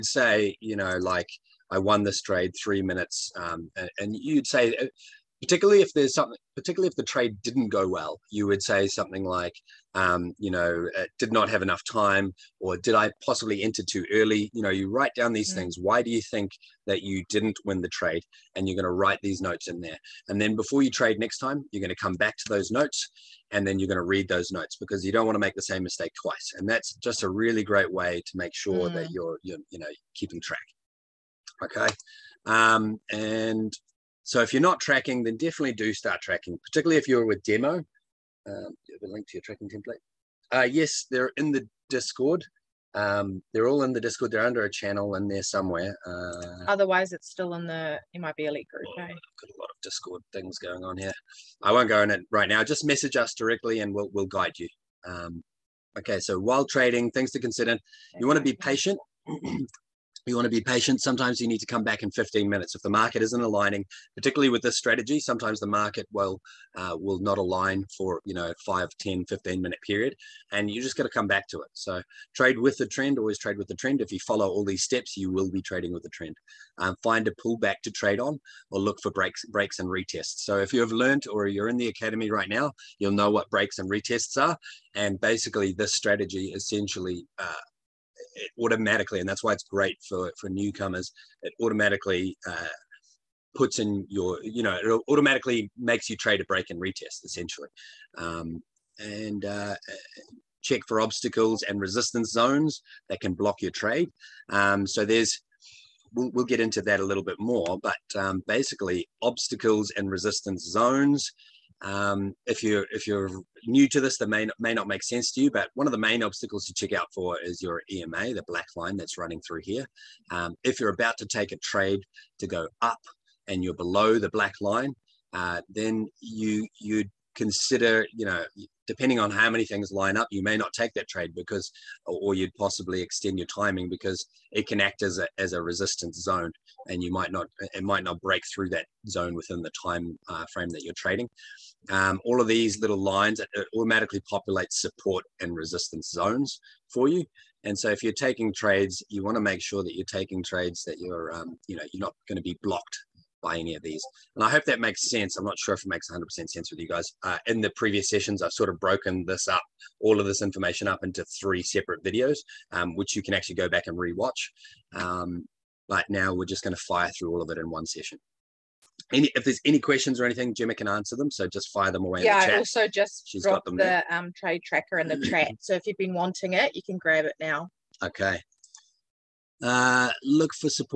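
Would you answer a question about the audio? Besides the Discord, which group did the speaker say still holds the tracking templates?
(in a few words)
MIB Elite group.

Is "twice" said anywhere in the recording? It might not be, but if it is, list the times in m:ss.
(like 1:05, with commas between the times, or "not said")
0:26.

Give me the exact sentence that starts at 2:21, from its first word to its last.
Um, all of these little lines, it uh, automatically populates support and resistance zones for you.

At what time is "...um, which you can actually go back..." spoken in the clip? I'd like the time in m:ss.
2:42.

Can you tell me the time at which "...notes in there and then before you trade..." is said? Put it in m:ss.
0:19.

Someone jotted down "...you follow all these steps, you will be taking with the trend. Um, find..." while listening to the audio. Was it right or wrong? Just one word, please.
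wrong.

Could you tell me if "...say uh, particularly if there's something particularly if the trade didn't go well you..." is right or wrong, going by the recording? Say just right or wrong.
right.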